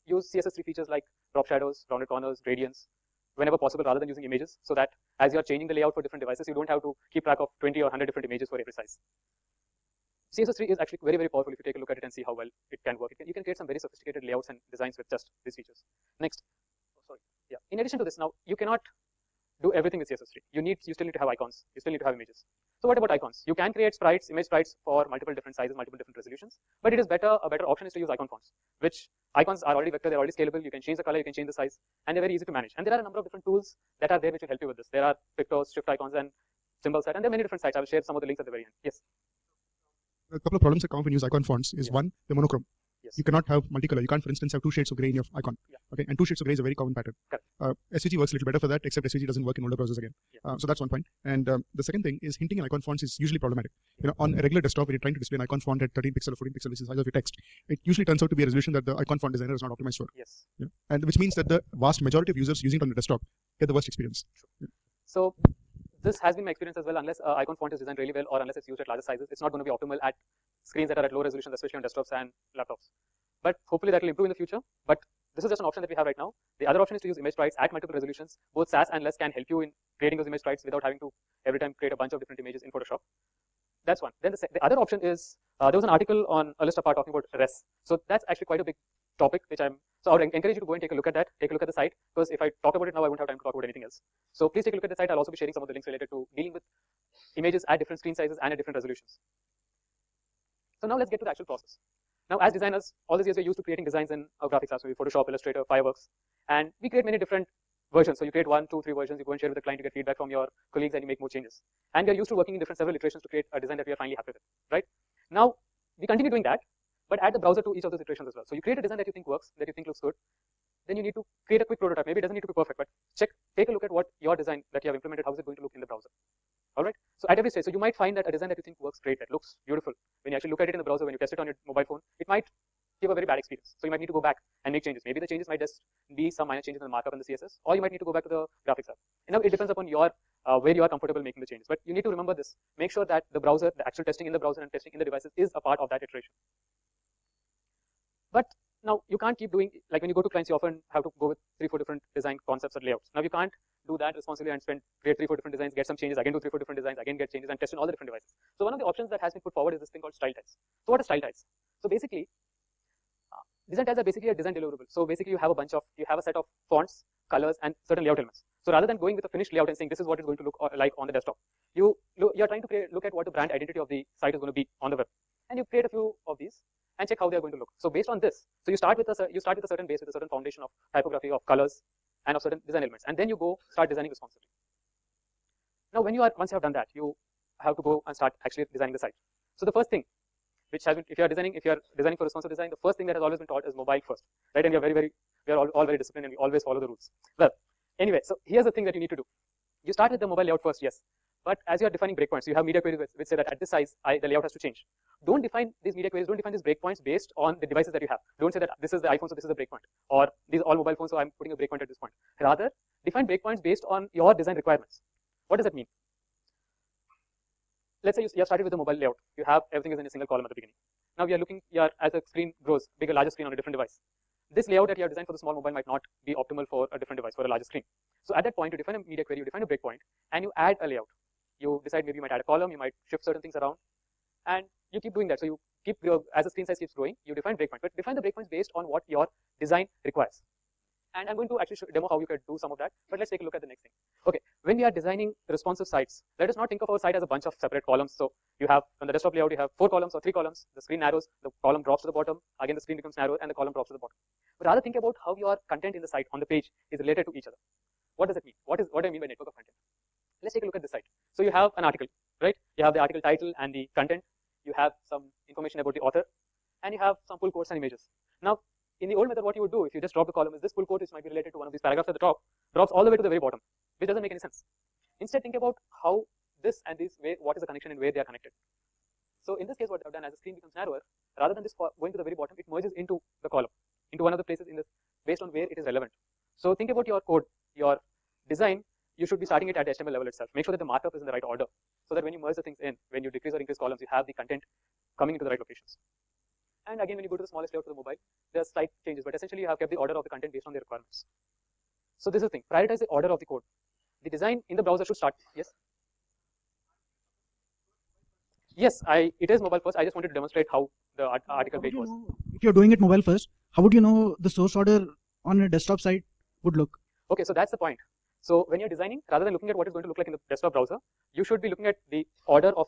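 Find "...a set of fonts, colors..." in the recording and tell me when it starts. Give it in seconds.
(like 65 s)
166 s.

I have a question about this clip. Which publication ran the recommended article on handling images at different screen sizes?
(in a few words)
A List Apart.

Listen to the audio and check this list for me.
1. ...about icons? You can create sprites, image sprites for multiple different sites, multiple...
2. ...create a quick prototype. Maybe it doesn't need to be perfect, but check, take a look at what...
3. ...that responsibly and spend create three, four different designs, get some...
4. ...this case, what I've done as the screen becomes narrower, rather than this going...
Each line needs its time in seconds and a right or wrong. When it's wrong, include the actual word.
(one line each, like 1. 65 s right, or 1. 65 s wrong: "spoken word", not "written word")
1. 22 s wrong: "sizes", not "sites"
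2. 121 s right
3. 154 s right
4. 279 s right.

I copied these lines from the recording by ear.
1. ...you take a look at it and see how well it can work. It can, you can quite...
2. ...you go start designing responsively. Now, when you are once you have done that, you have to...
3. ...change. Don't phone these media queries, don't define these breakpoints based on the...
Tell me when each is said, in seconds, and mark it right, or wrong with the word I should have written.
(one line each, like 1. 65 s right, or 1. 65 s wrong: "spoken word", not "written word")
1. 11 s wrong: "create", not "quite"
2. 183 s right
3. 204 s wrong: "define", not "phone".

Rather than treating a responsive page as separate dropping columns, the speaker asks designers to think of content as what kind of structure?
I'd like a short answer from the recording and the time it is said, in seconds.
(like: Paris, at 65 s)
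Network of content, at 259 s.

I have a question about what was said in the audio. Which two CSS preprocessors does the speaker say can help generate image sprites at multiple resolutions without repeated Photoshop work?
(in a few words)
Sass and Less.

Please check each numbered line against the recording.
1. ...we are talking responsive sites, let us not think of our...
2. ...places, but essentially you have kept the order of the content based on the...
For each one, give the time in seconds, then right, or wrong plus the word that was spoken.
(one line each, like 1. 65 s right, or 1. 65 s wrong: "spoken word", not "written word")
1. 244 s wrong: "designing", not "talking"
2. 299 s wrong: "changes", not "places".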